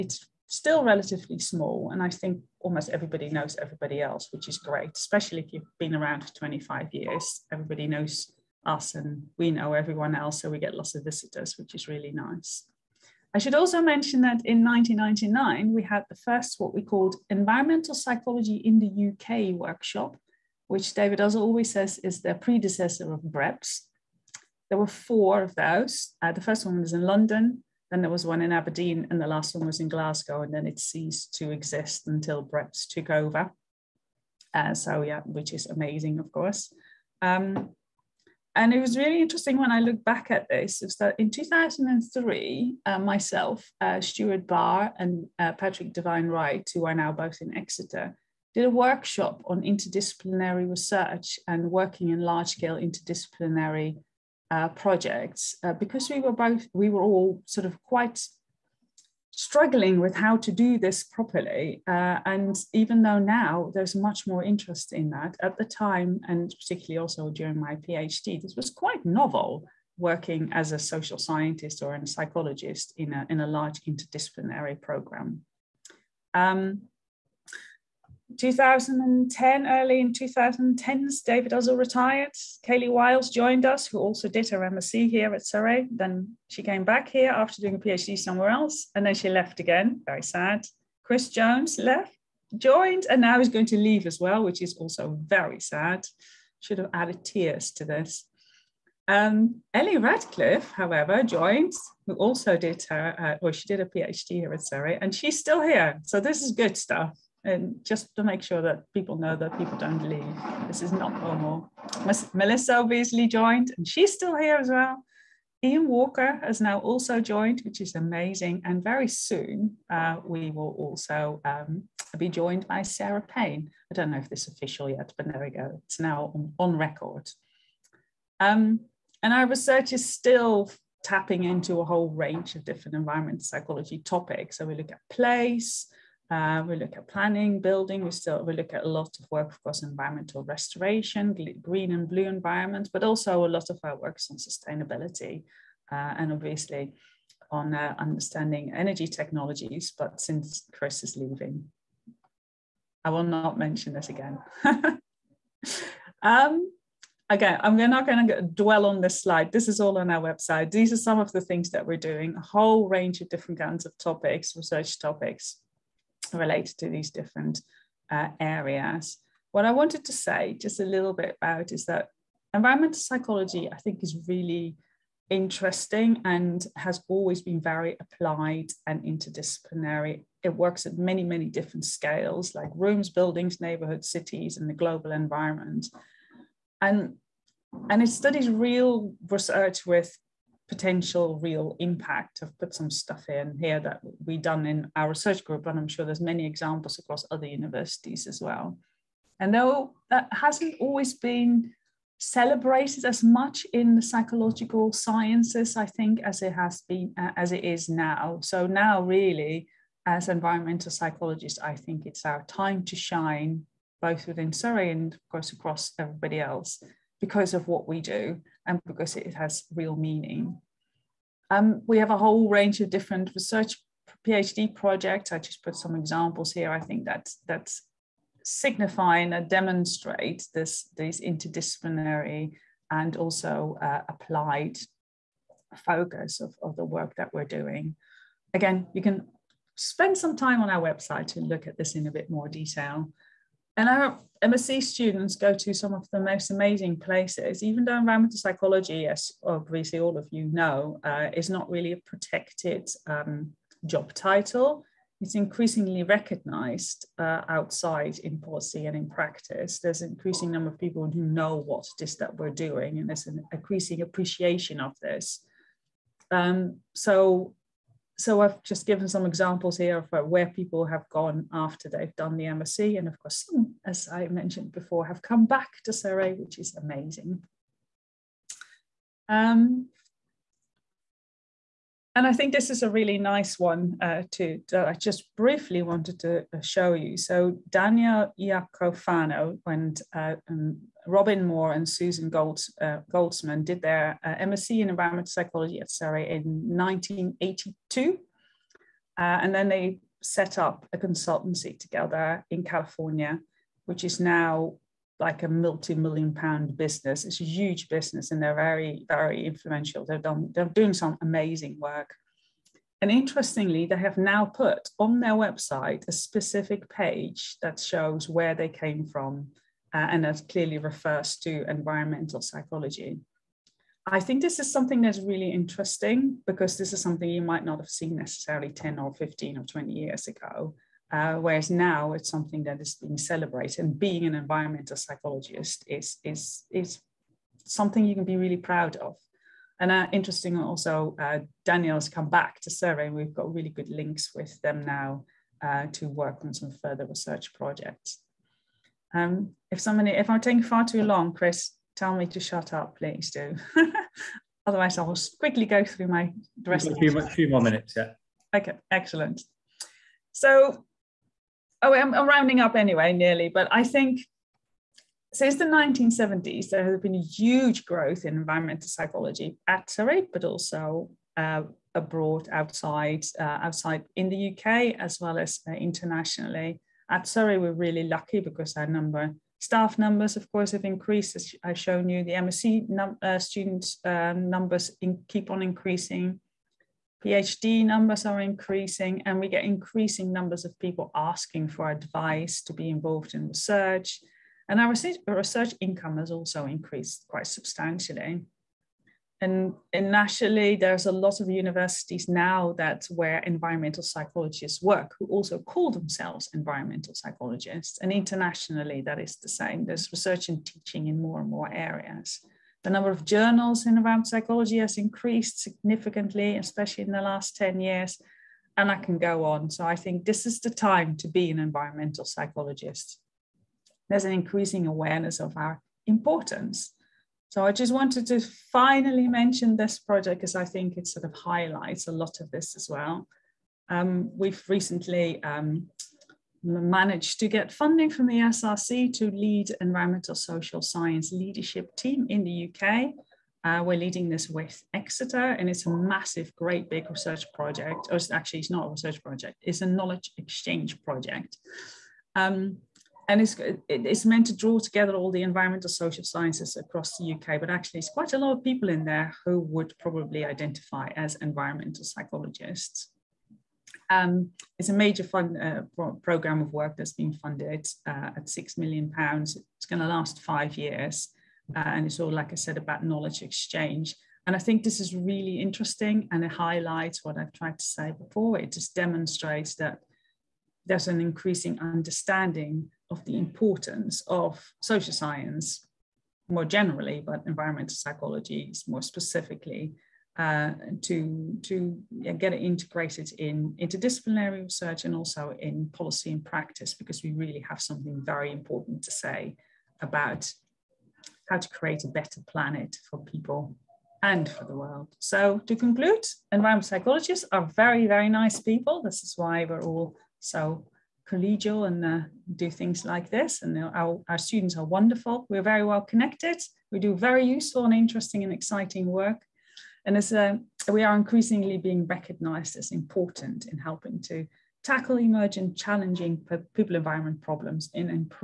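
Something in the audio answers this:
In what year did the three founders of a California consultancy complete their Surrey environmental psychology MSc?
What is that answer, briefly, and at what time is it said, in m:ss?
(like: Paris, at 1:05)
1982, at 4:56.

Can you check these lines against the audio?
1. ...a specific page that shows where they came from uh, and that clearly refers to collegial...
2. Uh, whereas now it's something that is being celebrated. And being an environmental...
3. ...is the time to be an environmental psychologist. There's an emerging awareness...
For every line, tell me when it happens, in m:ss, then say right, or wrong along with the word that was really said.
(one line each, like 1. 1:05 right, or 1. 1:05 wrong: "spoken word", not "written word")
1. 5:16 wrong: "environmental", not "collegial"
2. 5:31 right
3. 7:00 wrong: "increasing", not "emerging".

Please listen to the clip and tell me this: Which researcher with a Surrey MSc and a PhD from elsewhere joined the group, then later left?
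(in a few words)
Kayleigh Wyles.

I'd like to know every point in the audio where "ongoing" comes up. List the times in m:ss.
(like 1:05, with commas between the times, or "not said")
not said.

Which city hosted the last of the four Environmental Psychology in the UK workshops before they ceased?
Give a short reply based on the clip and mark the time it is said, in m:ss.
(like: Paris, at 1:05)
Glasgow, at 0:29.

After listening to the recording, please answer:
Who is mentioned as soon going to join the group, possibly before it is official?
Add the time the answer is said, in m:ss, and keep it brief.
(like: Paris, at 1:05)
Sarah Payne, at 2:02.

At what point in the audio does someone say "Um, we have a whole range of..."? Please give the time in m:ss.
3:41.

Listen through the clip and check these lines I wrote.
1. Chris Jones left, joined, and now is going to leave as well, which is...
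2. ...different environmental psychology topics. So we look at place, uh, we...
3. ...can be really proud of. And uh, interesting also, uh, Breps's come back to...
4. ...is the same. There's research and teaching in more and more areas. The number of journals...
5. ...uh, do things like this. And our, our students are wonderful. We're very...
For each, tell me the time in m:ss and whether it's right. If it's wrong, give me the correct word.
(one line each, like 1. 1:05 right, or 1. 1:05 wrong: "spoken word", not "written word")
1. 1:31 right
2. 2:12 right
3. 5:38 wrong: "Daniel", not "Breps"
4. 6:49 right
5. 8:32 right.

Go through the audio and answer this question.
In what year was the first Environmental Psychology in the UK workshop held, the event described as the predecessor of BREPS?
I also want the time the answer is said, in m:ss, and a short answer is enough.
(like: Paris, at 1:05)
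1999, at 0:14.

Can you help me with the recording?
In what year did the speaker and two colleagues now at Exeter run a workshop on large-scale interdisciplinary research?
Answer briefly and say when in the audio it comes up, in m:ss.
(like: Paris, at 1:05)
2003, at 0:41.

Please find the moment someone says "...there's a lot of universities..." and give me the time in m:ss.
6:40.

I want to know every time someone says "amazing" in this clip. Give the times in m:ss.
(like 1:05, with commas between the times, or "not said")
0:35, 1:57, 4:06, 4:36, 5:11.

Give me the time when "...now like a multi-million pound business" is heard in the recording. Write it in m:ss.
5:04.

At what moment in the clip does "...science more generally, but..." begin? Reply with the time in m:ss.
8:05.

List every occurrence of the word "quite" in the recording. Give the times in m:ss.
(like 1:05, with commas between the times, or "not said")
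0:57, 1:08, 6:37, 7:38.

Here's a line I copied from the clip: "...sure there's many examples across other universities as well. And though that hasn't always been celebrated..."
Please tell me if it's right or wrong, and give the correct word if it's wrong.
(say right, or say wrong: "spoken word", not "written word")
right.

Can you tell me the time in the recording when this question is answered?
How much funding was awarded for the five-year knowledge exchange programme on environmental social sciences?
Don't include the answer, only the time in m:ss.
7:48.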